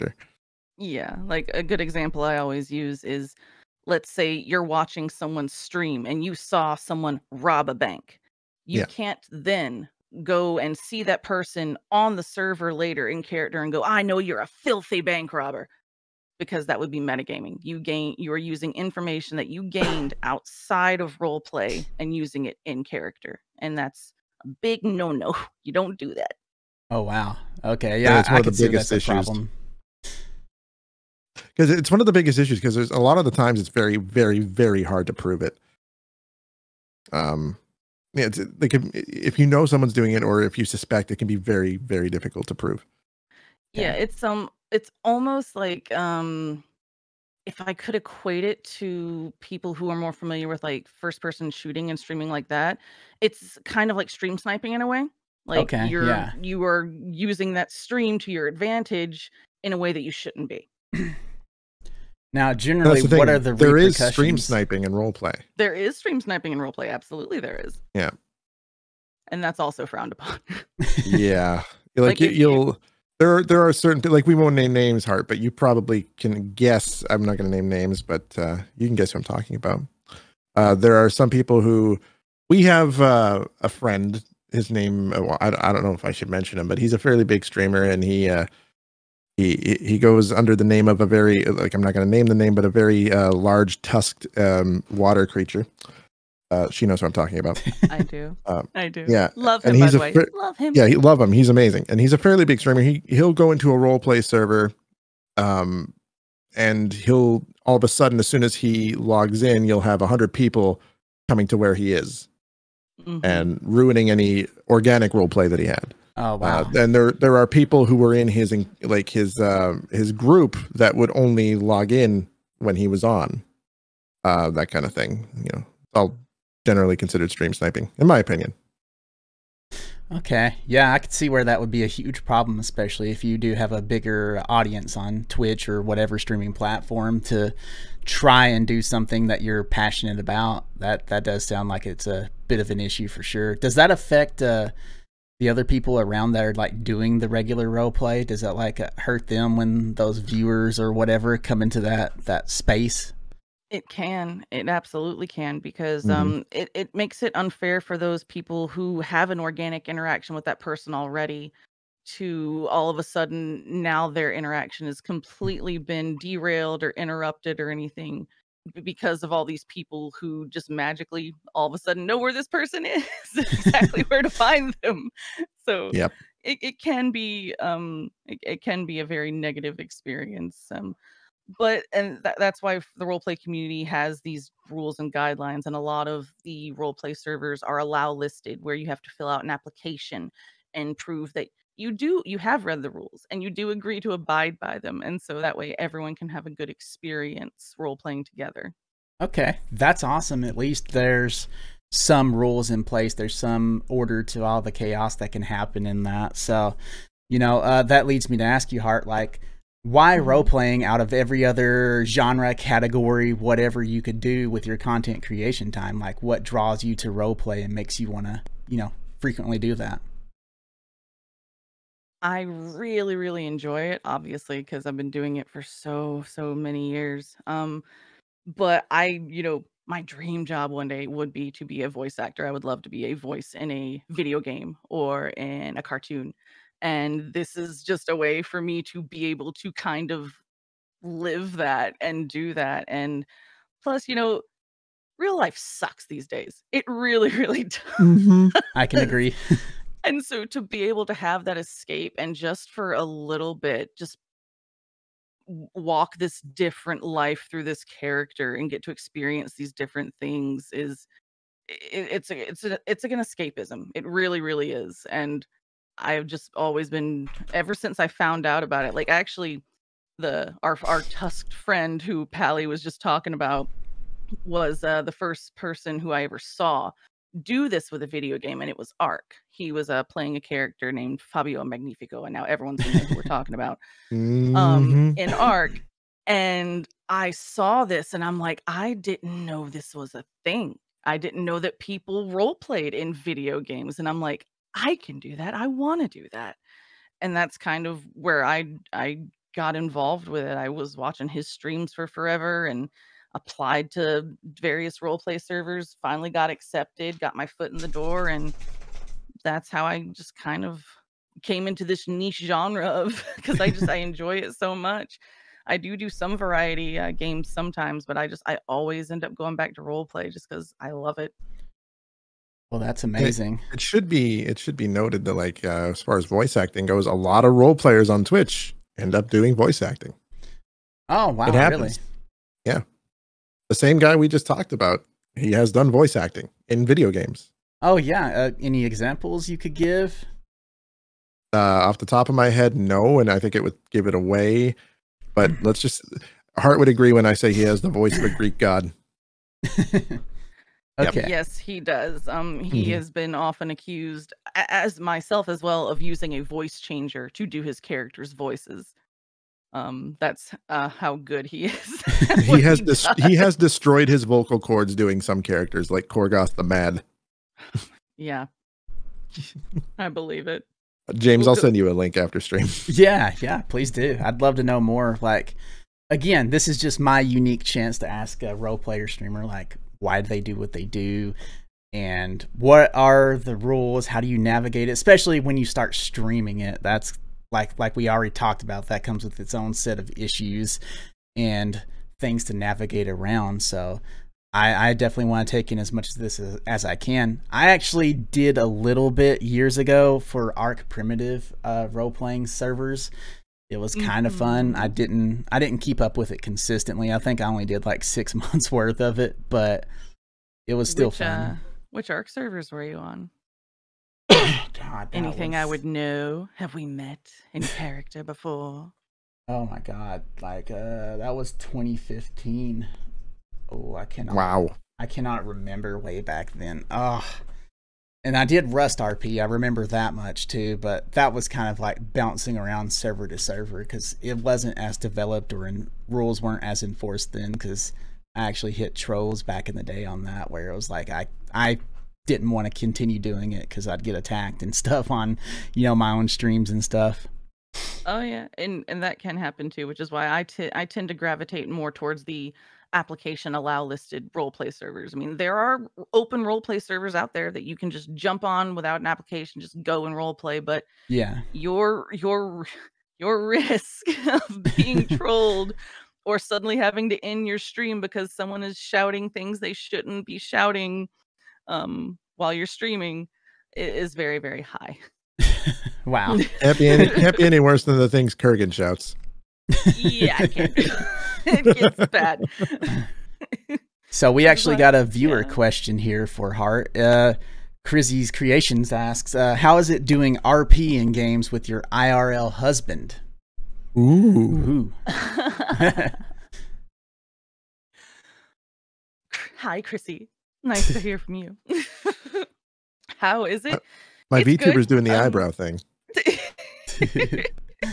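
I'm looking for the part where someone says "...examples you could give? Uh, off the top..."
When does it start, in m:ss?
5:38.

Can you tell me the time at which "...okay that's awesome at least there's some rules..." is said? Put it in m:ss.
3:19.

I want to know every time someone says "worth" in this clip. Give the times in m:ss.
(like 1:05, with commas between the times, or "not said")
6:48.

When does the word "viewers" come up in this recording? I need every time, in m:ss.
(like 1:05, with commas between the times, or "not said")
2:30, 8:05.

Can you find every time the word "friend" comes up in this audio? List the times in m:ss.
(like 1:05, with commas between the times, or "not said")
1:23, 4:31.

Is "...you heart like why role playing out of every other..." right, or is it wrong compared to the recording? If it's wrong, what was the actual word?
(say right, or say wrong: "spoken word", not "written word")
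right.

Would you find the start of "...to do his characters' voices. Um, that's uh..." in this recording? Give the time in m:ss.
5:57.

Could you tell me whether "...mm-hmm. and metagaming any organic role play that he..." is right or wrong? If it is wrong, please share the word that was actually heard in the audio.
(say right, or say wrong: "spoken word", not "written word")
wrong: "ruining", not "metagaming".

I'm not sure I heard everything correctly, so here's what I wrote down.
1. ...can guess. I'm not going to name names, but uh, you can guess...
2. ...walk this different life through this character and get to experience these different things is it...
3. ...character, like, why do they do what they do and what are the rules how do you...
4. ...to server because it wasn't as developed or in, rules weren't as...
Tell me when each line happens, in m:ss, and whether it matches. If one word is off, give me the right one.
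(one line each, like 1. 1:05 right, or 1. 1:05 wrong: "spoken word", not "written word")
1. 1:16 right
2. 4:15 right
3. 6:19 wrong: "streamer", not "character"
4. 7:13 right.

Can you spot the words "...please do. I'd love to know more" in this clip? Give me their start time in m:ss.
6:13.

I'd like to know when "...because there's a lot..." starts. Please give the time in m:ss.
0:32.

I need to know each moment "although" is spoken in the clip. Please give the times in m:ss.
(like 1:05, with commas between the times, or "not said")
not said.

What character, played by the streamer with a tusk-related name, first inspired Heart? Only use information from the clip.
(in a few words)
Fabio Magnifico.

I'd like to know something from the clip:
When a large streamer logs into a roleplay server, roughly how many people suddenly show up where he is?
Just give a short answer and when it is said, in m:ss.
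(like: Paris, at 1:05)
100, at 1:49.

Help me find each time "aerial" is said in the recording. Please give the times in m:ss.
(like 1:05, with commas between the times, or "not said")
not said.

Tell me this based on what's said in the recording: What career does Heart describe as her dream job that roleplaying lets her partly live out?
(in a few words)
Voice actor.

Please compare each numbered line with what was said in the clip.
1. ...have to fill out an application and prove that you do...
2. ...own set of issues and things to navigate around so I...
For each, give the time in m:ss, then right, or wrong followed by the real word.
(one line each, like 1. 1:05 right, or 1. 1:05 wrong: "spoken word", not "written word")
1. 3:08 right
2. 6:29 right.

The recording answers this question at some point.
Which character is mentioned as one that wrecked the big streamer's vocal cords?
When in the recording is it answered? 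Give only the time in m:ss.
6:06.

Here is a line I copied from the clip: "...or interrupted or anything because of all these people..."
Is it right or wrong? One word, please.
right.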